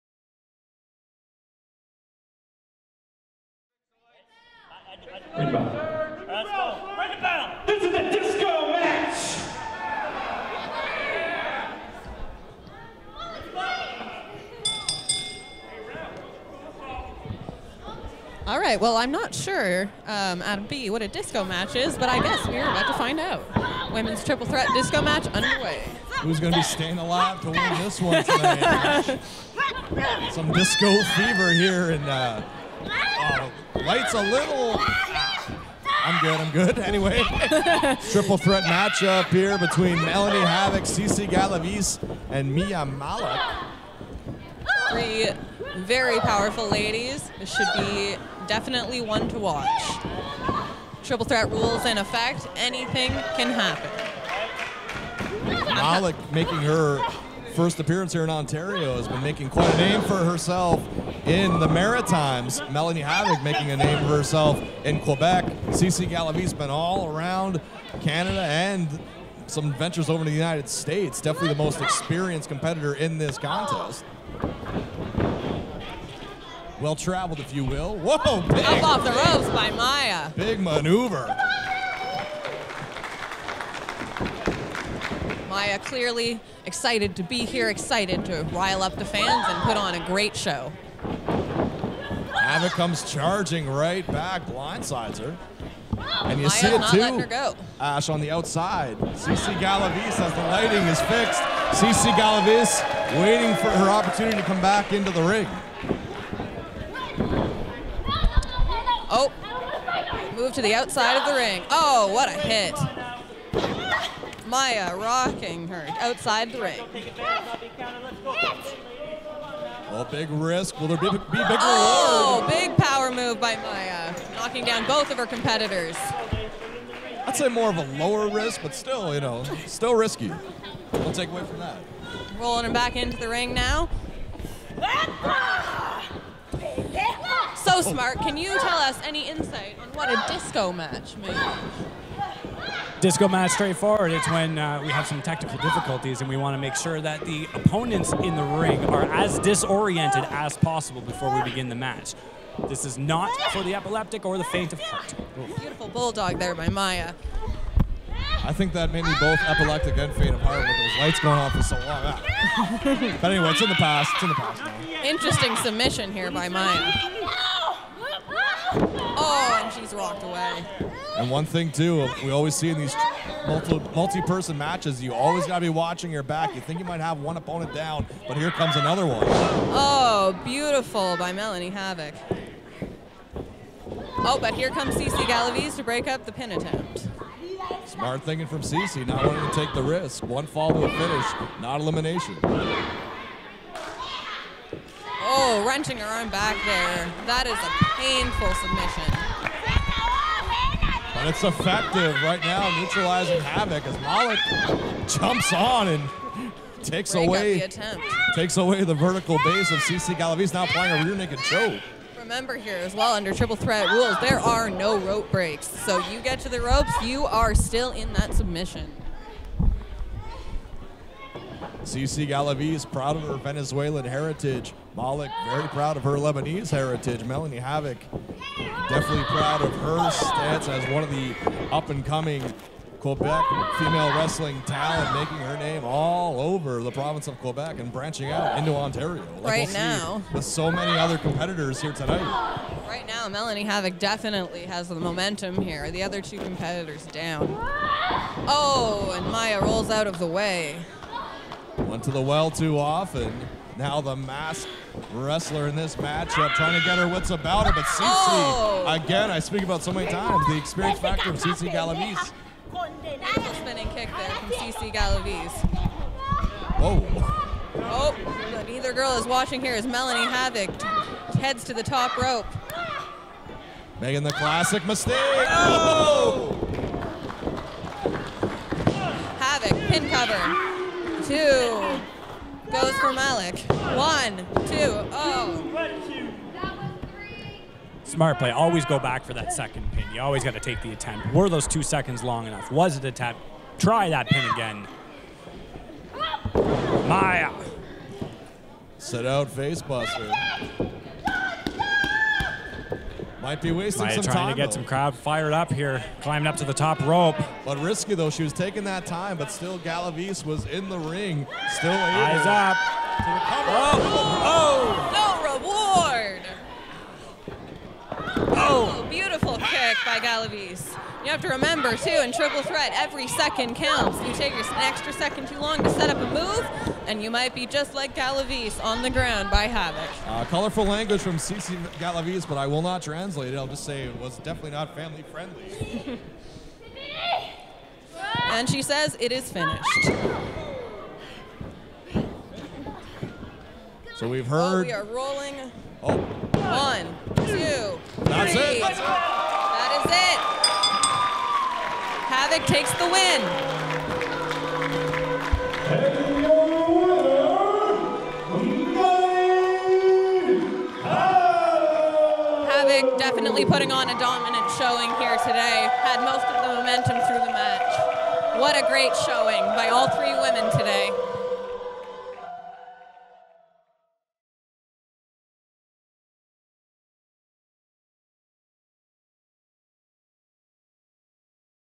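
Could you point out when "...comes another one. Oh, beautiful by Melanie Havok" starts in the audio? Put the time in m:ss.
2:58.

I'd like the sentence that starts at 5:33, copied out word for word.
I'll just say it was definitely not family friendly.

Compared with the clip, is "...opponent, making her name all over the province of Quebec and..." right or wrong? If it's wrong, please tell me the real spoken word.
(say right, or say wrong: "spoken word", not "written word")
wrong: "talent", not "opponent".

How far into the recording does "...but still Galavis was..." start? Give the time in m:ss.
5:09.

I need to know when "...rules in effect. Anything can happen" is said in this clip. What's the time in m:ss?
0:51.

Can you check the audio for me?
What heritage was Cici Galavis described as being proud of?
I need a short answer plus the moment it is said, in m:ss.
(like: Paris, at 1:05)
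Venezuelan, at 3:43.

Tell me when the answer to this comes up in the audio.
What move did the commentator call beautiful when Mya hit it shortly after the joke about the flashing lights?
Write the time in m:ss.
2:35.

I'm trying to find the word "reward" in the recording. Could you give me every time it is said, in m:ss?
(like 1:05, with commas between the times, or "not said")
2:01, 5:16.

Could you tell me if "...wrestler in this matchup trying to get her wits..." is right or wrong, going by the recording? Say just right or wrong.
right.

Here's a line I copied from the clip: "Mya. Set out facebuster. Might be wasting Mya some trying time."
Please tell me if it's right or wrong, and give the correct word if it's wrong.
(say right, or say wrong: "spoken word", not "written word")
right.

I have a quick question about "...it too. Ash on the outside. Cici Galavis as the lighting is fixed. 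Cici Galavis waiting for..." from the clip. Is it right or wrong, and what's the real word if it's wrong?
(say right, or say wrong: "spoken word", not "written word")
right.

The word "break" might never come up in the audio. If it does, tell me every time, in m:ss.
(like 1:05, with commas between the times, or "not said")
3:05, 3:27, 3:35.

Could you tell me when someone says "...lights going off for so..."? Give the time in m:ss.
2:40.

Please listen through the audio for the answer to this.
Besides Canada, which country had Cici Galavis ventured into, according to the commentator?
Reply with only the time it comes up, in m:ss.
1:10.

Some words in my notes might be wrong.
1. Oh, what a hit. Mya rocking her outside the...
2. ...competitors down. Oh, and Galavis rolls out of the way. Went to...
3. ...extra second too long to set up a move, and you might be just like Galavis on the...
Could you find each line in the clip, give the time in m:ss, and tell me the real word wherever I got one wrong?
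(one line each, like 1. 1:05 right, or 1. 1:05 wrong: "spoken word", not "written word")
1. 1:51 right
2. 4:06 wrong: "Mya", not "Galavis"
3. 5:24 right.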